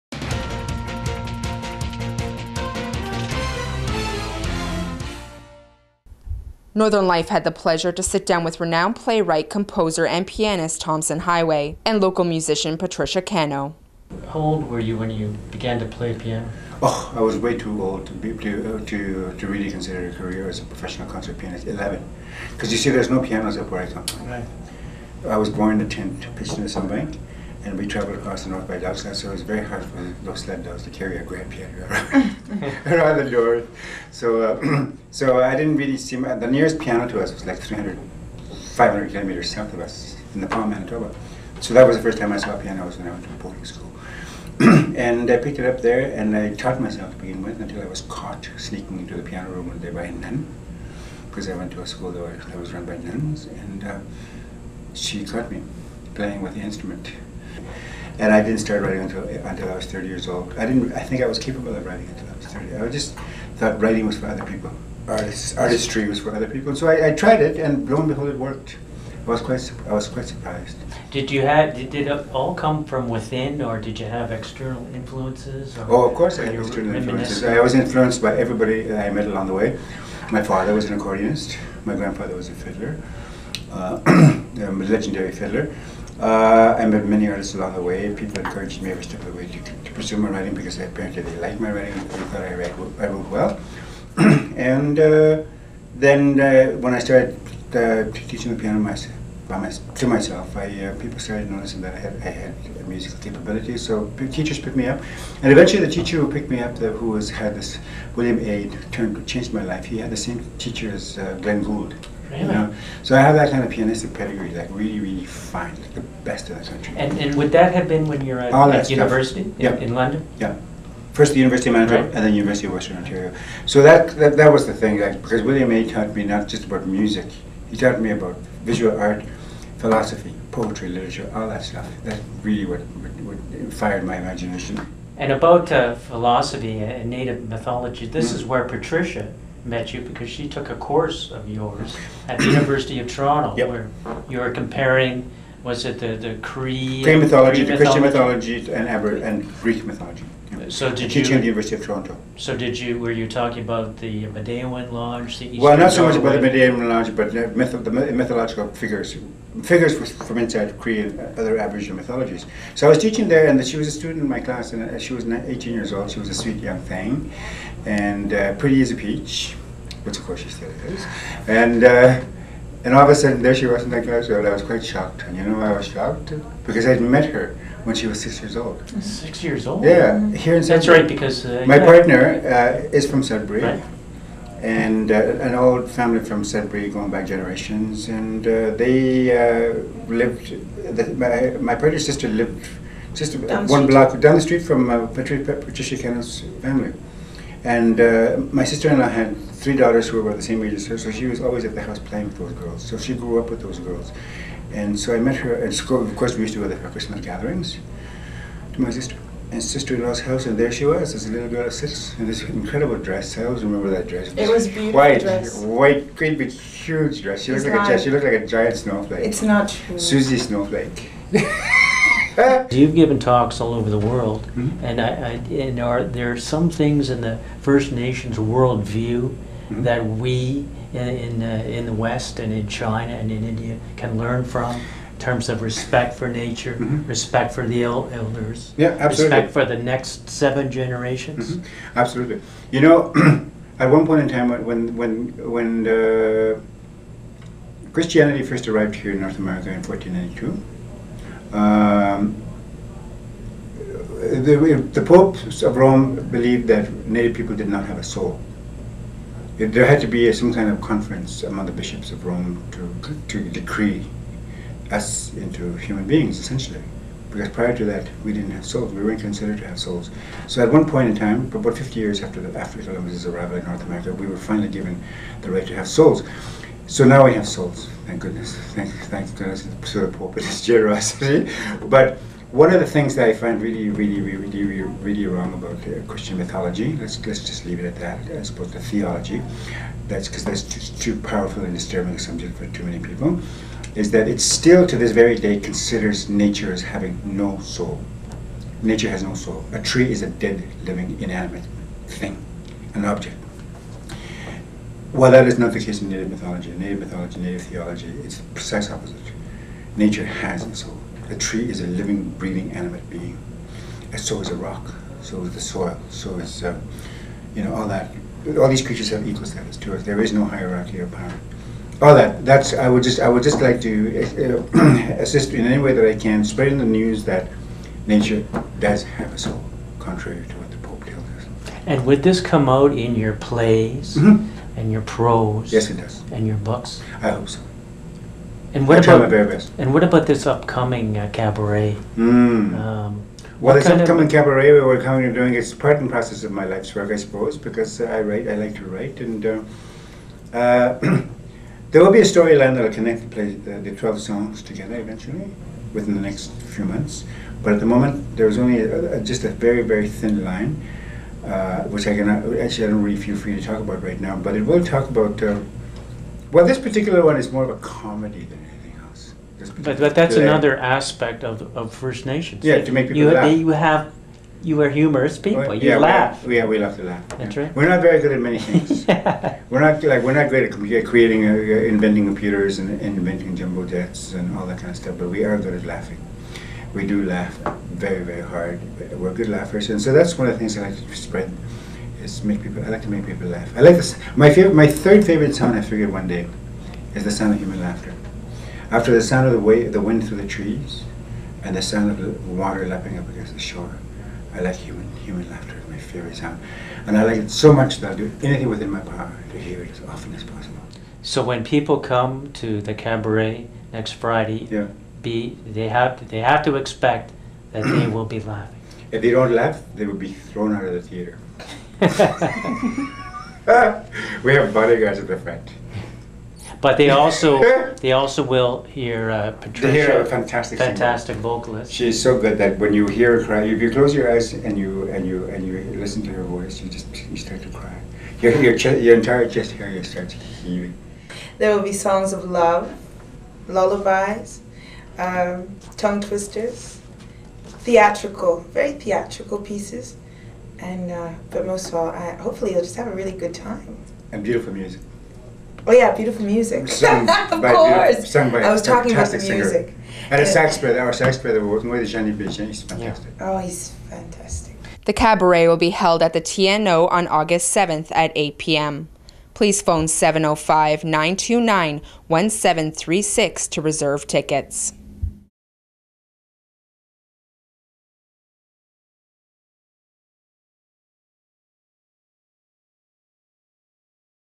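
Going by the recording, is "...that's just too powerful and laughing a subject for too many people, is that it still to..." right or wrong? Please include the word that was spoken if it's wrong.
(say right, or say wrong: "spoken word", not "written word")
wrong: "disturbing", not "laughing".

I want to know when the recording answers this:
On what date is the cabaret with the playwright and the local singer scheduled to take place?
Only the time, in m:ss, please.
7:47.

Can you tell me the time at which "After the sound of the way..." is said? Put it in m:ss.
6:38.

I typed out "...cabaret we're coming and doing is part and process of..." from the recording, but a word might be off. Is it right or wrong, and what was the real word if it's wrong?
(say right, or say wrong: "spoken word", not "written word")
right.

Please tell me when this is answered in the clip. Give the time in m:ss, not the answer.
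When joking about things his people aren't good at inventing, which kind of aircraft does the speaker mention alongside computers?
6:23.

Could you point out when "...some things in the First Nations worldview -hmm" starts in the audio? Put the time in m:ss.
3:46.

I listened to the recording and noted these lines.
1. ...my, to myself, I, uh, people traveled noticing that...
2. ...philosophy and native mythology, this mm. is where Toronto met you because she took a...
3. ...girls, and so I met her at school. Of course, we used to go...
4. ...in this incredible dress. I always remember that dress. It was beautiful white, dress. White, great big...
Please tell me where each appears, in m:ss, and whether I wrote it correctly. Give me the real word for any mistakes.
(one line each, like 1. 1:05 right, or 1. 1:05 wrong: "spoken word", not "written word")
1. 1:39 wrong: "started", not "traveled"
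2. 2:15 wrong: "Patricia", not "Toronto"
3. 3:23 right
4. 3:32 right.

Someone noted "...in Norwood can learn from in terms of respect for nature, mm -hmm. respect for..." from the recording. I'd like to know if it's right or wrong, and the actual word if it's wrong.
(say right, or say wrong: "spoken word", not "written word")
wrong: "India", not "Norwood".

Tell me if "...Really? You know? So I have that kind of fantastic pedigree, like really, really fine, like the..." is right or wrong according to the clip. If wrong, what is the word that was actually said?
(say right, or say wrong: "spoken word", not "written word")
wrong: "pianistic", not "fantastic".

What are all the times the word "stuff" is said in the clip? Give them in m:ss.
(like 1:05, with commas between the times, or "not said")
2:11, 6:24.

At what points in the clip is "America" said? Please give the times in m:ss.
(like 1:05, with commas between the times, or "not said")
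4:09, 4:33.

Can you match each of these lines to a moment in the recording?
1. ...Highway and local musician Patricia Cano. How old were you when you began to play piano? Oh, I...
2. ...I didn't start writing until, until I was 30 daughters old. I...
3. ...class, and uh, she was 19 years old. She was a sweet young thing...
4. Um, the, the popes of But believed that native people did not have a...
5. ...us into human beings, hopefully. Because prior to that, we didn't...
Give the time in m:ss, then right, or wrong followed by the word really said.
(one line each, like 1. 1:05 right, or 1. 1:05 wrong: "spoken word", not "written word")
1. 0:11 right
2. 0:58 wrong: "years", not "daughters"
3. 2:44 wrong: "18", not "19"
4. 4:11 wrong: "Rome", not "But"
5. 4:24 wrong: "essentially", not "hopefully".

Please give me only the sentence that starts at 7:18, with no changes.
Your your, chest, your entire chest area starts heaving.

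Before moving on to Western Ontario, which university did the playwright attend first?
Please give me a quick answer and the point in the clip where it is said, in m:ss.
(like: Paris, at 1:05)
University of Manitoba, at 2:01.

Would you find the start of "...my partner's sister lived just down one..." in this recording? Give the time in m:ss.
3:11.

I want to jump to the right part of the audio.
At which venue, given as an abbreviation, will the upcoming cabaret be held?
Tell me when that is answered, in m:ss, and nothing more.
7:46.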